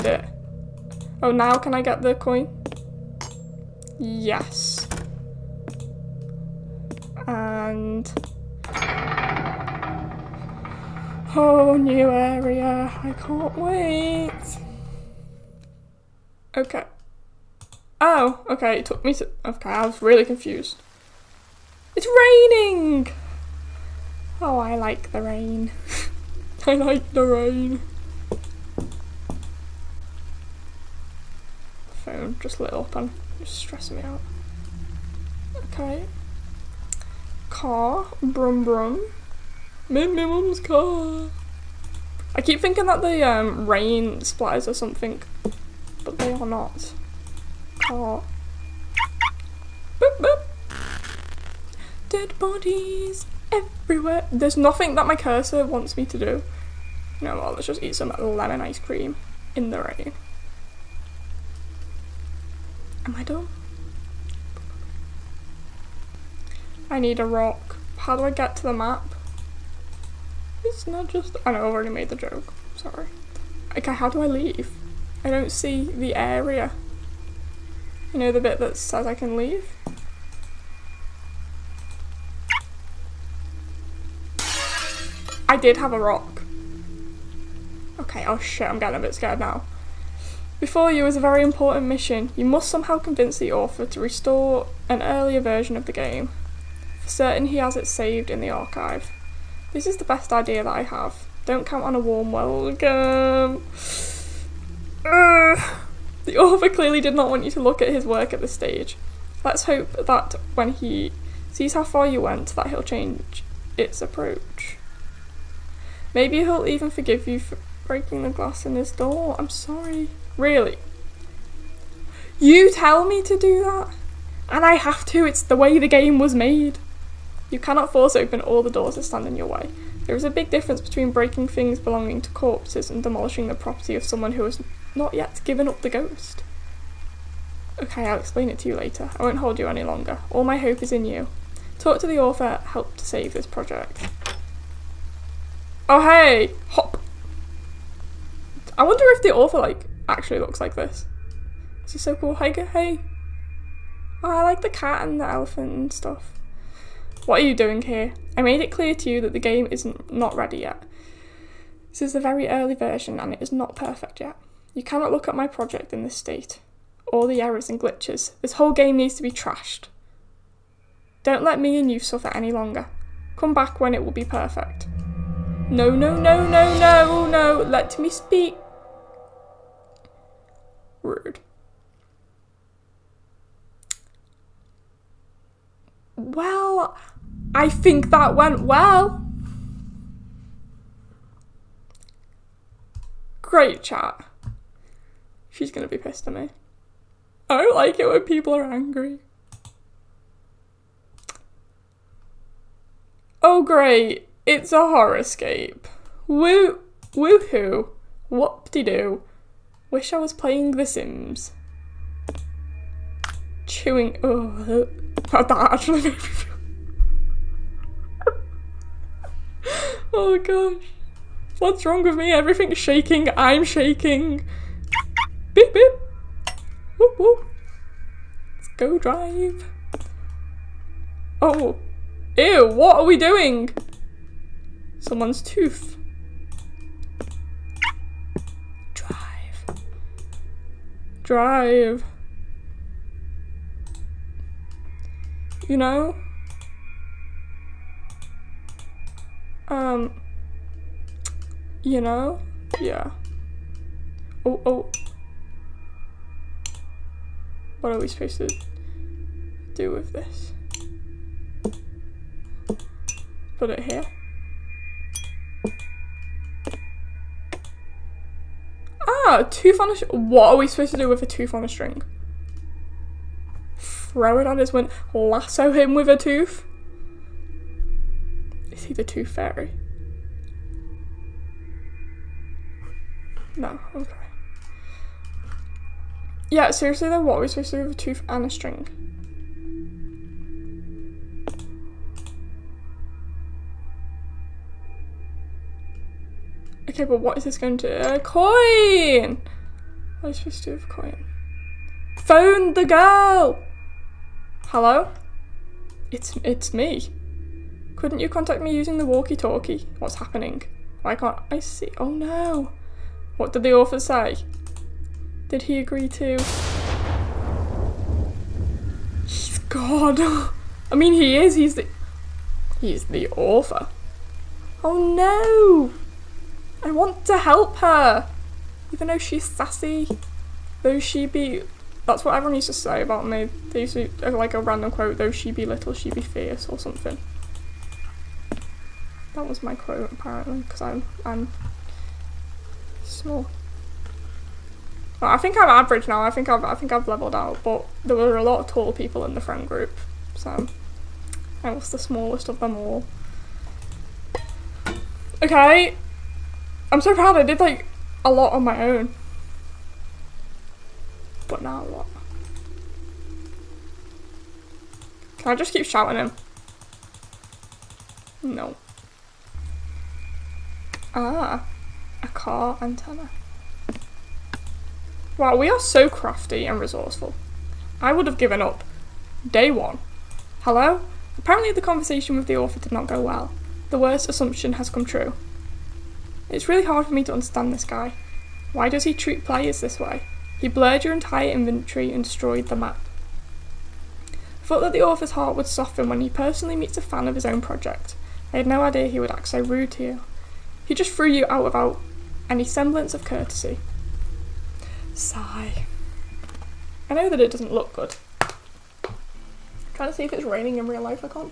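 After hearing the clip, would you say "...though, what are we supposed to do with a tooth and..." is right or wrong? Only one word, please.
right.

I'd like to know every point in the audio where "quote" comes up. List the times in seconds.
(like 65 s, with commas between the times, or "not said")
334 s, 339 s.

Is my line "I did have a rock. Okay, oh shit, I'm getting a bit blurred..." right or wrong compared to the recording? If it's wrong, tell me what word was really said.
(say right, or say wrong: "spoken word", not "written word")
wrong: "scared", not "blurred".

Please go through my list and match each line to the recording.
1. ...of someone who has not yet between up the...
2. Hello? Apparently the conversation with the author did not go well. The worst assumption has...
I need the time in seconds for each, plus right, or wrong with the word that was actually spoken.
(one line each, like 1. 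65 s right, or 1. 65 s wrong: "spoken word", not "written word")
1. 133 s wrong: "given", not "between"
2. 380 s right.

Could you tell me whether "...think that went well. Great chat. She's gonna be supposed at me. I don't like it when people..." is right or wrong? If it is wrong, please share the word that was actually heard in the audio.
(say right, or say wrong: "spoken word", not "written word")
wrong: "pissed", not "supposed".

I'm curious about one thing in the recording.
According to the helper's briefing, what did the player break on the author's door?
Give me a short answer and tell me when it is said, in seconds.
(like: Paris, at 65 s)
The glass, at 117 s.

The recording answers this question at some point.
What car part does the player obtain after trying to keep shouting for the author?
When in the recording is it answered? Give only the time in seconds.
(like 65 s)
372 s.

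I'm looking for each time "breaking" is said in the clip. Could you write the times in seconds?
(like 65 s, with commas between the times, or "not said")
117 s, 131 s.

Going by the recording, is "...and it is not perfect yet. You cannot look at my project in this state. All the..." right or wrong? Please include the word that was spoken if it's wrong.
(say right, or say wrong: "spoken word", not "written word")
right.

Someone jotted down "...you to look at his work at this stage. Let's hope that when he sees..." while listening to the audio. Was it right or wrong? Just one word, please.
right.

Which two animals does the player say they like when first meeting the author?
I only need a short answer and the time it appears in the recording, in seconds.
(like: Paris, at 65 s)
The cat and the elephant, at 154 s.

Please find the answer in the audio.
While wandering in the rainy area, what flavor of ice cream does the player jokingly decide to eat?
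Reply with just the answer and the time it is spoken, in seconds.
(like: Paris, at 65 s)
Lemon, at 58 s.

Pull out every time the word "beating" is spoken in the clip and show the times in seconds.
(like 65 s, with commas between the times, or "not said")
not said.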